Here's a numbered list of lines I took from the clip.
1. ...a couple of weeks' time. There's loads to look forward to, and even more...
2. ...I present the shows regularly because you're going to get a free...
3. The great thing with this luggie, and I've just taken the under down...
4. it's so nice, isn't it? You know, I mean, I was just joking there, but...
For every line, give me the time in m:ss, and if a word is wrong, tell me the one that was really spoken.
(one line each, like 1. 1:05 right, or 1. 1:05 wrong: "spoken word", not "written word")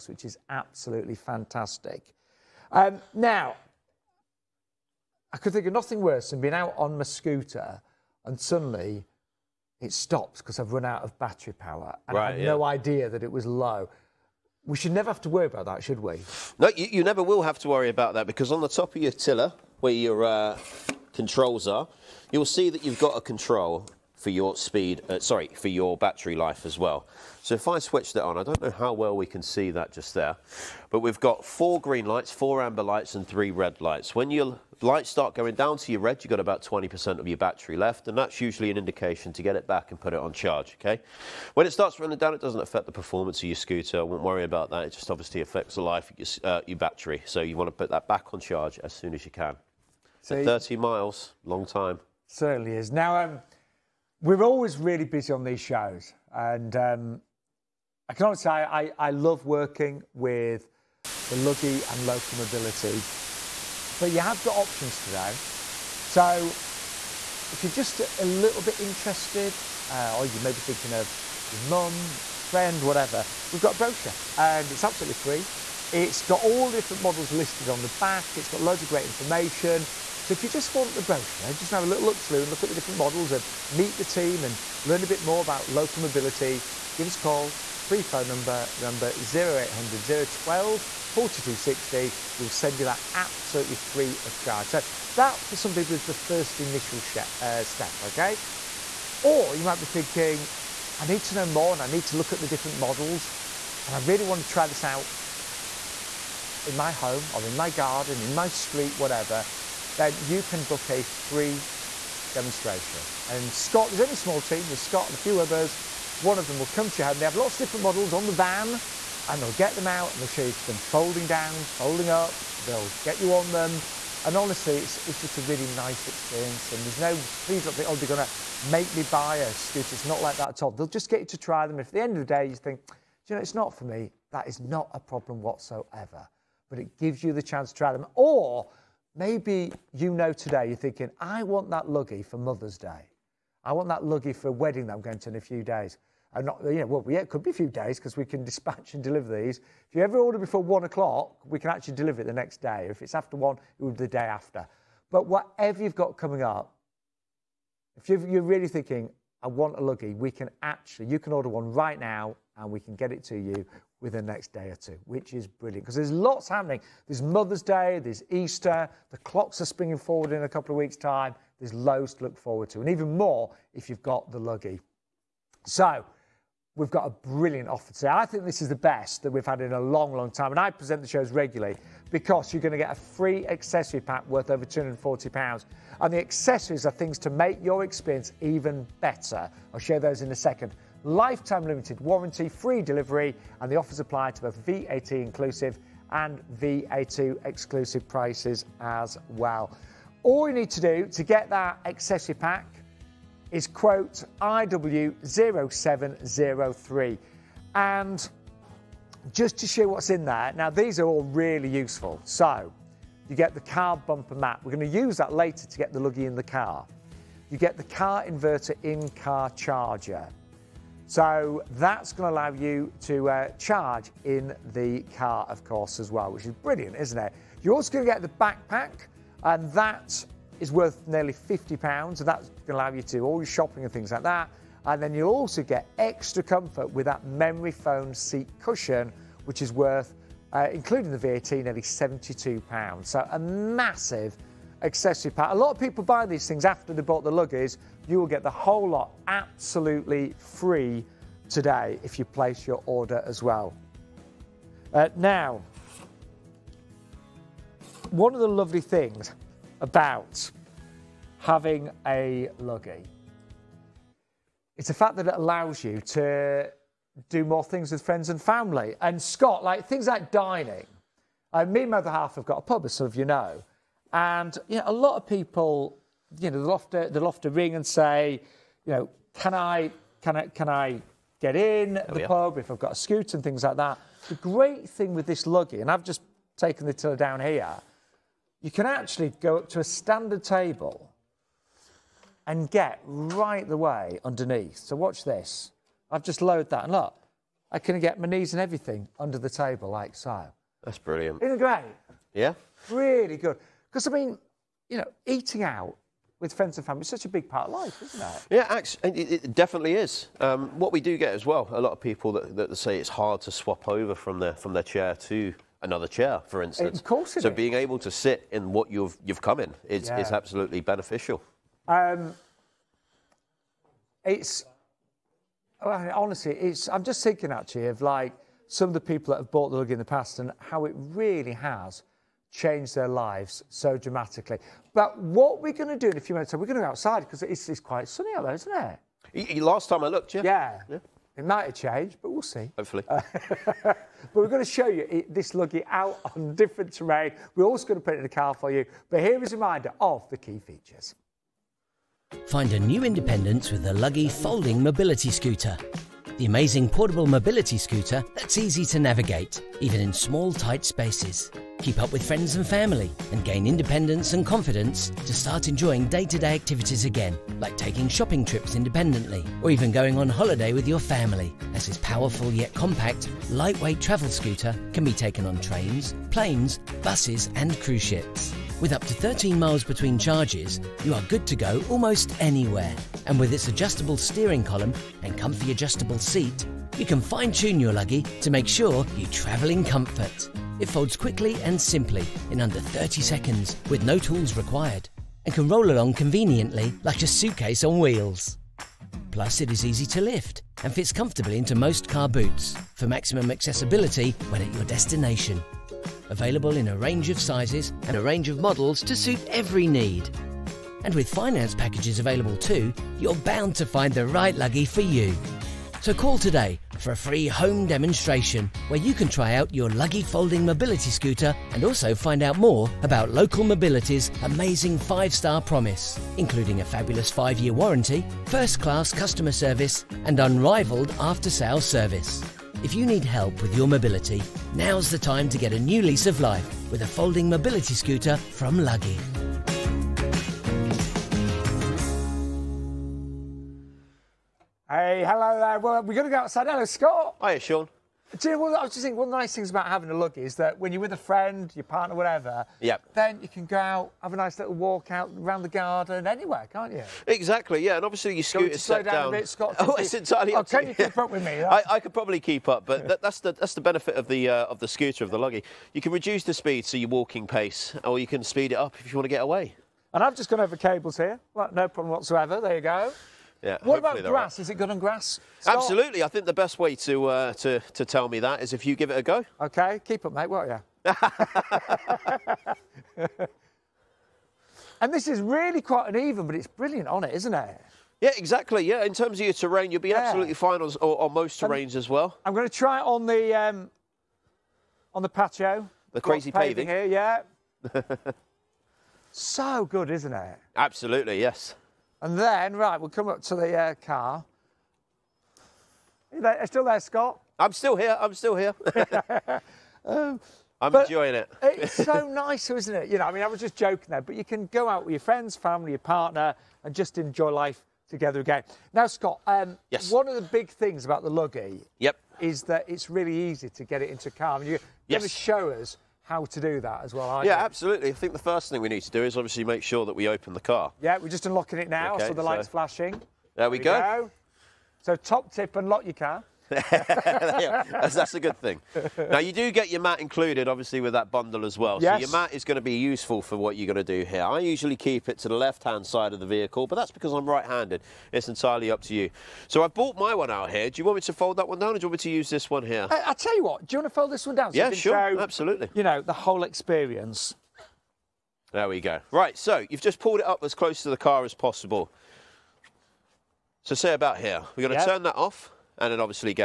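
1. 2:50 right
2. 3:00 right
3. 4:44 wrong: "tiller", not "under"
4. 8:31 right.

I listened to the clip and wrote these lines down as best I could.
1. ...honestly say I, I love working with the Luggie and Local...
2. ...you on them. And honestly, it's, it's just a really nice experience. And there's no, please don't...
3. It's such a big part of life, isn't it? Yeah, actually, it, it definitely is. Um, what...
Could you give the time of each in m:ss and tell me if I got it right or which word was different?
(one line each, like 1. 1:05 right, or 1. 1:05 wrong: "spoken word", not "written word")
1. 0:58 right
2. 2:03 right
3. 5:06 right.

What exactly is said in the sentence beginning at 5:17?
being able to sit in what you've you've come in is yeah.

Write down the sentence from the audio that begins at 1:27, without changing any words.
Free phone number, remember 0800 012 4260.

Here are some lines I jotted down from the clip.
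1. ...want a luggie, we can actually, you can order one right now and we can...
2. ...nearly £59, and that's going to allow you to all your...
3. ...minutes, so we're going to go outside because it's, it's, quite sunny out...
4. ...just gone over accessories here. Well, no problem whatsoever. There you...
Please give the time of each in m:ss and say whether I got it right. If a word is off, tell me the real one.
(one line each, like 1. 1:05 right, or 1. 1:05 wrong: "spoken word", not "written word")
1. 2:39 right
2. 3:51 wrong: "50", not "59"
3. 5:36 right
4. 7:50 wrong: "cables", not "accessories".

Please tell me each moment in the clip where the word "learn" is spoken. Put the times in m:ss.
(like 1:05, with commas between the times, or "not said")
1:24.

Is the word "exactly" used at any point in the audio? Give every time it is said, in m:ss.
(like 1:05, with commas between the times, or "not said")
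7:37, 8:08.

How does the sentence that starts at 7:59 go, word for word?
OK, keep it, mate, won't you?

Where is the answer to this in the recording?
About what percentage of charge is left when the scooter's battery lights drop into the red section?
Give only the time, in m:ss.
0:36.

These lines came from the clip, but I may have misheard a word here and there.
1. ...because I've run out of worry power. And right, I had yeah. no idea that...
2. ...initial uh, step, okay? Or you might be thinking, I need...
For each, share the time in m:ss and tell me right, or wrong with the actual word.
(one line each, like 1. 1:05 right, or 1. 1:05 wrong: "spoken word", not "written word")
1. 0:10 wrong: "battery", not "worry"
2. 1:36 right.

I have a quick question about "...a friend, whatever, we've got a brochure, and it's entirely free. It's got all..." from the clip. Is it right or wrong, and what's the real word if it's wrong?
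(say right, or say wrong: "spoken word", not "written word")
wrong: "absolutely", not "entirely".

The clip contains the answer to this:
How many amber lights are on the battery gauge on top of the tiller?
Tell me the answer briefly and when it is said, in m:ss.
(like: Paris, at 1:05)
4, at 0:32.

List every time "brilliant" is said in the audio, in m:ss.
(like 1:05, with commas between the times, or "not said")
2:45, 2:57, 3:46, 5:00, 8:06.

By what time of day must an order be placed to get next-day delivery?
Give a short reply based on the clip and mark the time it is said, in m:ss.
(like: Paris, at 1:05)
1 o'clock, at 2:30.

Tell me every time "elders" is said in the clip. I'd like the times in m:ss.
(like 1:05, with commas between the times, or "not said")
not said.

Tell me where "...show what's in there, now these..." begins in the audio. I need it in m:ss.
3:29.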